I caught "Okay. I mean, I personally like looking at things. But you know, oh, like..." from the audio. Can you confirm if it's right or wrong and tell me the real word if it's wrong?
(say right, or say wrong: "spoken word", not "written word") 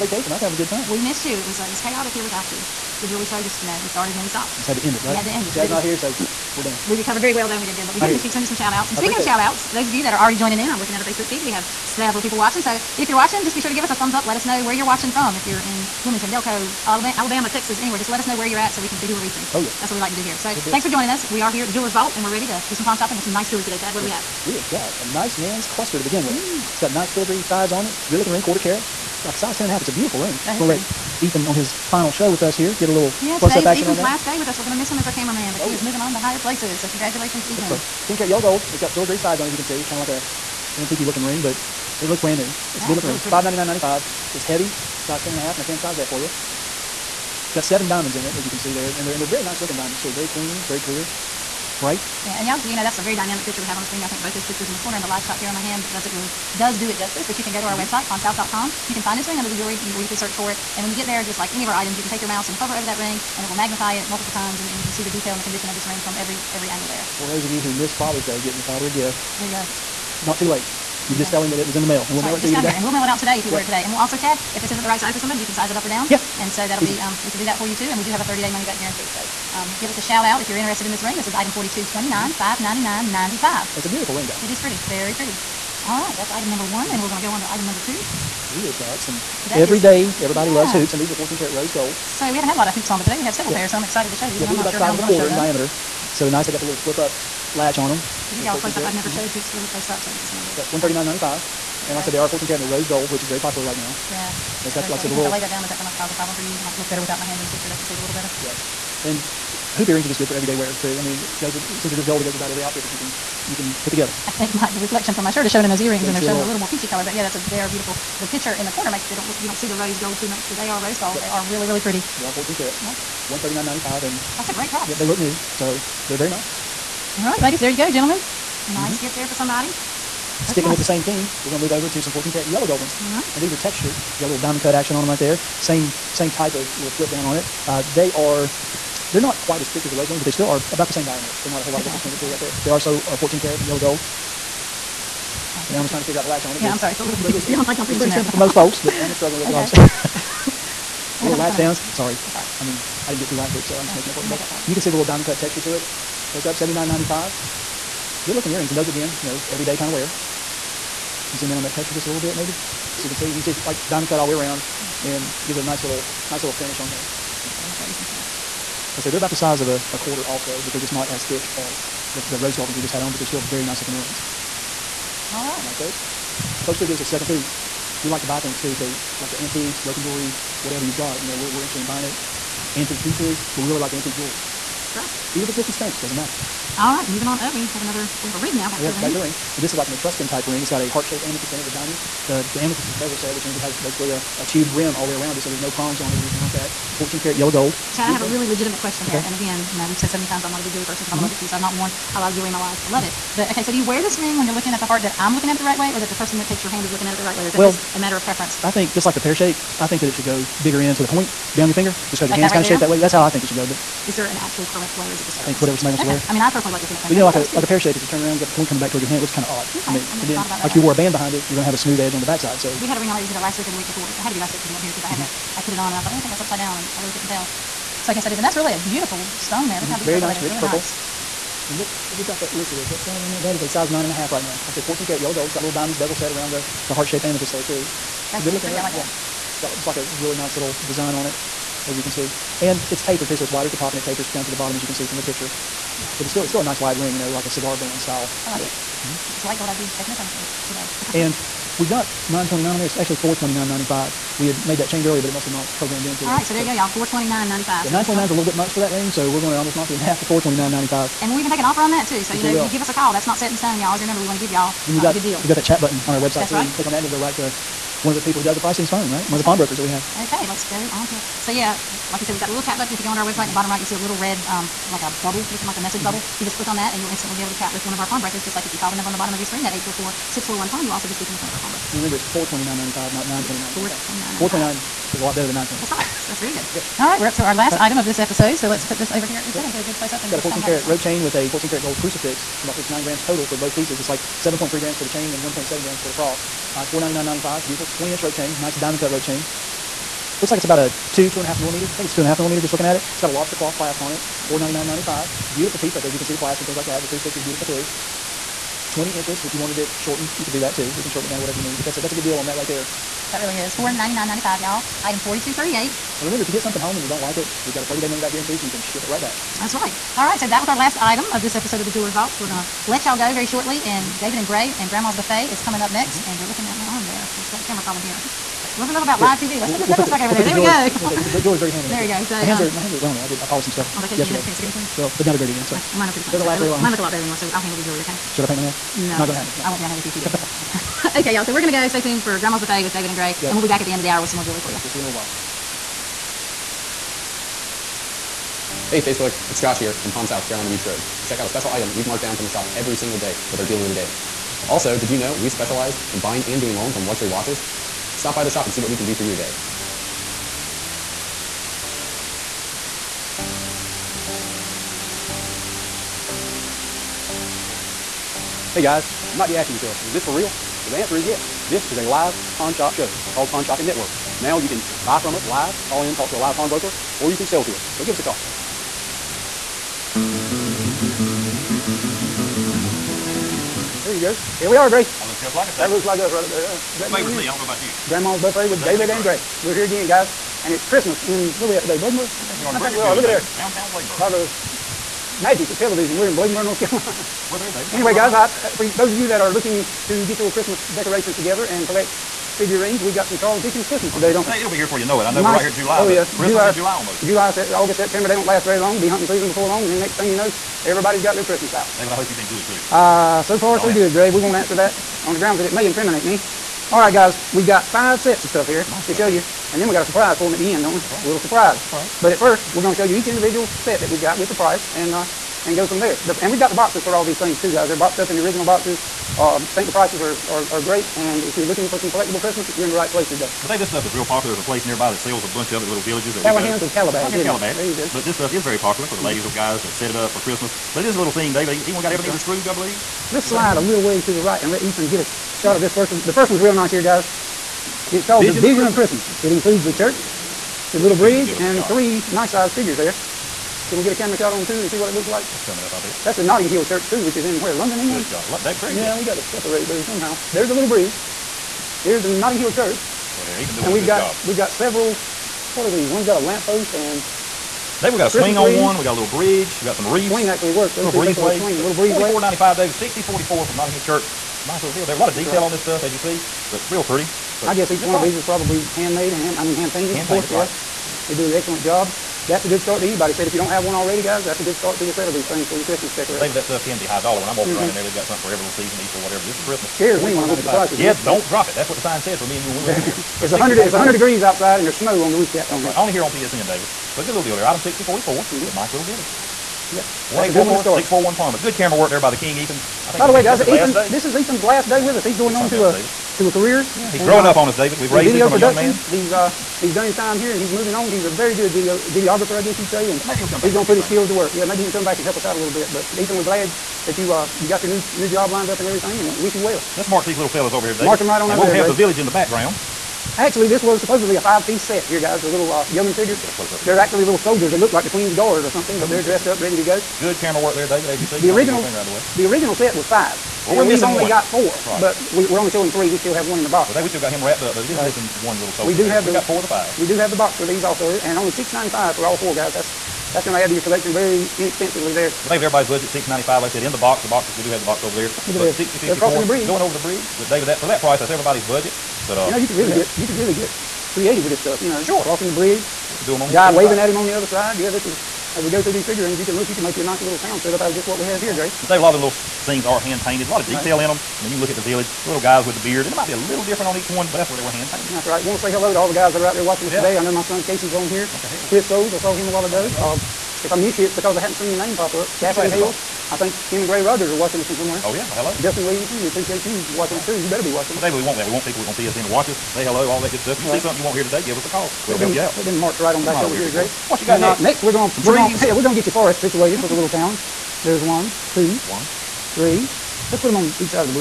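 right.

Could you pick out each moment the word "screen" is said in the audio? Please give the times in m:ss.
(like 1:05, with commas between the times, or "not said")
0:53, 4:39.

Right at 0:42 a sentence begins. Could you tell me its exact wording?
It's that a good looking really ring.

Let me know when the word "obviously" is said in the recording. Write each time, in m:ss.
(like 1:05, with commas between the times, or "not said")
2:29.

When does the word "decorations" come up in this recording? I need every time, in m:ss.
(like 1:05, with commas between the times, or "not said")
6:40, 8:06.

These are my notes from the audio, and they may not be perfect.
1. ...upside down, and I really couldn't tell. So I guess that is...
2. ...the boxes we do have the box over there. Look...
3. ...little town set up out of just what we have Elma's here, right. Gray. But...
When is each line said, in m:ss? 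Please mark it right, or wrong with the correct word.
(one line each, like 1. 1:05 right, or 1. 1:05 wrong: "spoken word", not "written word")
1. 3:46 right
2. 9:07 right
3. 9:20 wrong: "That", not "Elma".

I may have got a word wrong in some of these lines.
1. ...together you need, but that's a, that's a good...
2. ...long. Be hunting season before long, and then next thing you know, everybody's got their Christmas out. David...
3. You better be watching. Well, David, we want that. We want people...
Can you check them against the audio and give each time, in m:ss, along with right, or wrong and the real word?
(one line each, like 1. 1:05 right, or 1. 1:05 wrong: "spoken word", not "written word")
1. 5:11 wrong: "whatever", not "together"
2. 6:48 right
3. 9:40 right.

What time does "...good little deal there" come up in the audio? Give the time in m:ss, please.
8:17.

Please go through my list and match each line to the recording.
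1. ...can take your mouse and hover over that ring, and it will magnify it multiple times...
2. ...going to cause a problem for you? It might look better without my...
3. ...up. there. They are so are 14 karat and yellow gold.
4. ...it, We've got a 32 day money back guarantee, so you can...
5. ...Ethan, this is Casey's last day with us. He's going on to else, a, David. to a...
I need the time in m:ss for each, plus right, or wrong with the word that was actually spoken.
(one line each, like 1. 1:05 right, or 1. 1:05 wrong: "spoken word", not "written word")
1. 1:02 right
2. 1:45 right
3. 2:22 right
4. 5:17 wrong: "30", not "32"
5. 8:23 wrong: "Ethan", not "Casey".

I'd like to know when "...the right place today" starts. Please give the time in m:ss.
7:12.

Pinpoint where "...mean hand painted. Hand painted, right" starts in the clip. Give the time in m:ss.
7:59.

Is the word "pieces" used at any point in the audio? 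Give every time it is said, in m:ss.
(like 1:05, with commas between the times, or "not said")
3:03, 4:53, 5:05, 8:44.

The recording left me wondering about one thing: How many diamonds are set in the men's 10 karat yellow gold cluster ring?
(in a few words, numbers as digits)
7.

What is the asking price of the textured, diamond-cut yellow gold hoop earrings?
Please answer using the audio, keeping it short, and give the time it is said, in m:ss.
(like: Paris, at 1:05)
79.95, at 2:36.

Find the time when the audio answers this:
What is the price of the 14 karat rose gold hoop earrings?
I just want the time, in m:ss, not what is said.
1:40.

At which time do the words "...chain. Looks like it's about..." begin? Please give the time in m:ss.
4:59.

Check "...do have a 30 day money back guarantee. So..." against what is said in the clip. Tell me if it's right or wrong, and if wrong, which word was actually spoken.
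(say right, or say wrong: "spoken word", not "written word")
right.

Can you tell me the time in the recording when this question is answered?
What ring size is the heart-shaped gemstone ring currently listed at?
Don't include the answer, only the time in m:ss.
3:53.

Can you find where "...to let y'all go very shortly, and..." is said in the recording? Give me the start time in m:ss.
5:22.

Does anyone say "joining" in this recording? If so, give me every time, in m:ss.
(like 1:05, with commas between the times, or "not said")
0:10, 0:20.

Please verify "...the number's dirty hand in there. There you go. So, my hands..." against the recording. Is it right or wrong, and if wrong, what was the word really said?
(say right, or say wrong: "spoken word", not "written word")
wrong: "jeweler", not "number".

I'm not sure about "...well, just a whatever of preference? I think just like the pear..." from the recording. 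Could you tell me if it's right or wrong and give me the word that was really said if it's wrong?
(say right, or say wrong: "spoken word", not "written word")
wrong: "matter", not "whatever".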